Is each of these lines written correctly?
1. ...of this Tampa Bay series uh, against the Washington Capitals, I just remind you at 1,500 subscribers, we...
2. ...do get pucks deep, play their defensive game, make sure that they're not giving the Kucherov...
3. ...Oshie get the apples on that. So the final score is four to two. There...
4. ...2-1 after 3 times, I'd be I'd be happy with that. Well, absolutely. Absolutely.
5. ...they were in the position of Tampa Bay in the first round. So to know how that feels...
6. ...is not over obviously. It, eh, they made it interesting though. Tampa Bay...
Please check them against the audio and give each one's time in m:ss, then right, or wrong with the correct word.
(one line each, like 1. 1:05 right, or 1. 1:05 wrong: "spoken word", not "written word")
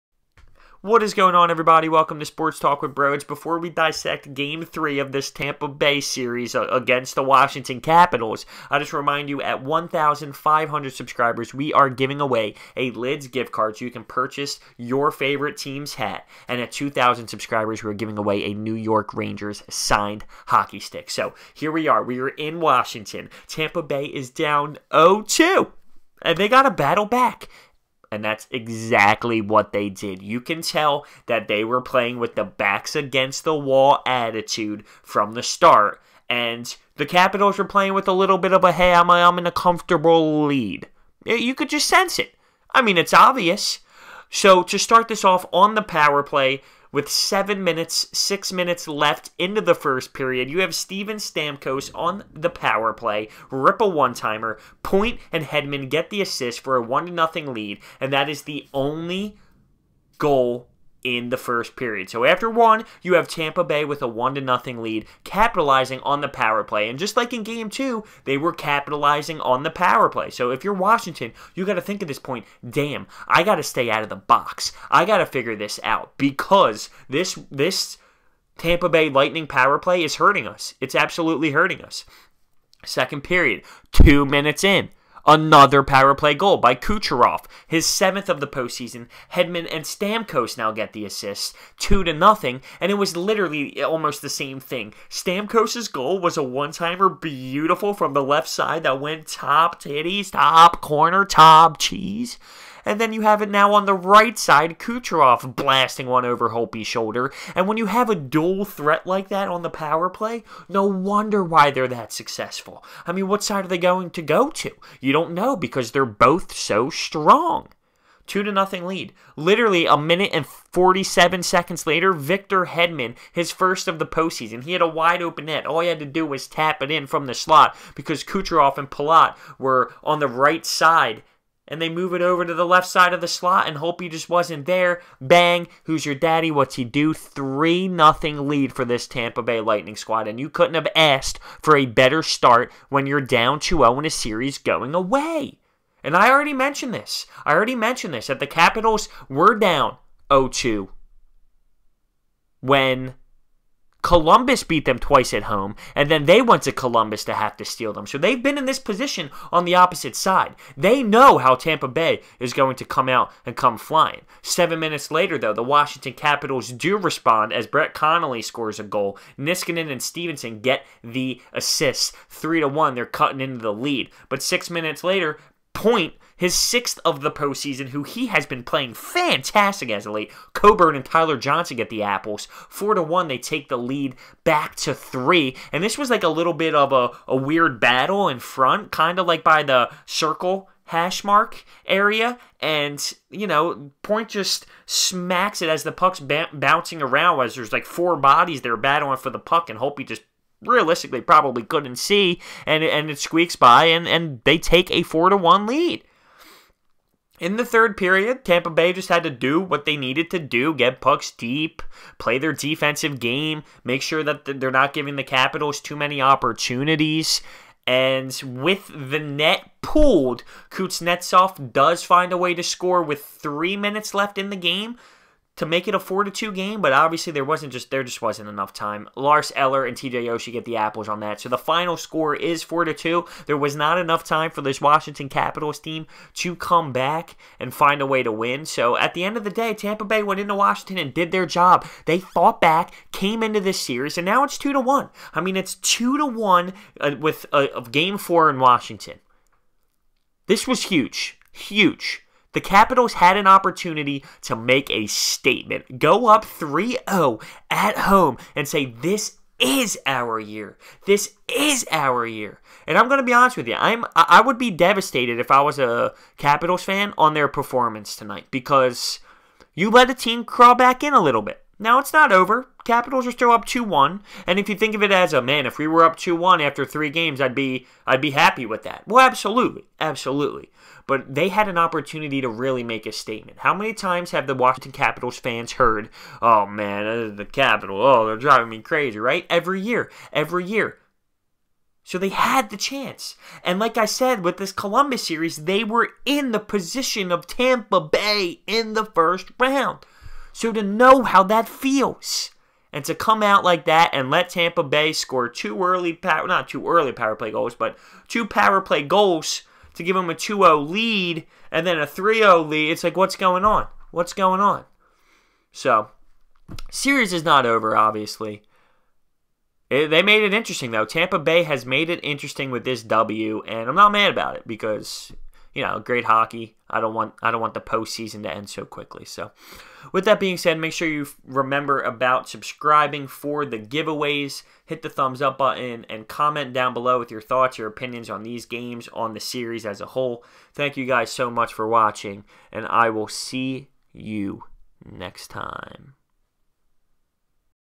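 1. 0:04 right
2. 3:30 wrong: "Capitals", not "Kucherov"
3. 3:50 right
4. 4:36 wrong: "games", not "times"
5. 4:55 right
6. 5:17 right.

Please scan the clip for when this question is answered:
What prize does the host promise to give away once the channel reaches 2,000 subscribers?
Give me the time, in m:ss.
0:18.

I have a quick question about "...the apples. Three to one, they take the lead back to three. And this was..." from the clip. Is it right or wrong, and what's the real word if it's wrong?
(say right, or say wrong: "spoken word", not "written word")
wrong: "Four", not "Three".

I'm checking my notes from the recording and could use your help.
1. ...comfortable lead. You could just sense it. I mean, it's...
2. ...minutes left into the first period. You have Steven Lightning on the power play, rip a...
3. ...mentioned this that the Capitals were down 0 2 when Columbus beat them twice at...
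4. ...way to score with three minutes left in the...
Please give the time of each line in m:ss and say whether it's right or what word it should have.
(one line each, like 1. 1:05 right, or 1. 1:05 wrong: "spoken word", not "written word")
1. 0:39 right
2. 0:48 wrong: "Stamkos", not "Lightning"
3. 2:27 right
4. 3:42 right.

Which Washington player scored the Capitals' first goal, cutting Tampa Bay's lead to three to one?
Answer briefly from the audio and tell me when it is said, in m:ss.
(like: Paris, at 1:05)
Brett Connolly, at 2:47.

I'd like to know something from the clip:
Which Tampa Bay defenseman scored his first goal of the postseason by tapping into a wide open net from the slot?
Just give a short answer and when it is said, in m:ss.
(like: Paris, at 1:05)
Victor Hedman, at 2:02.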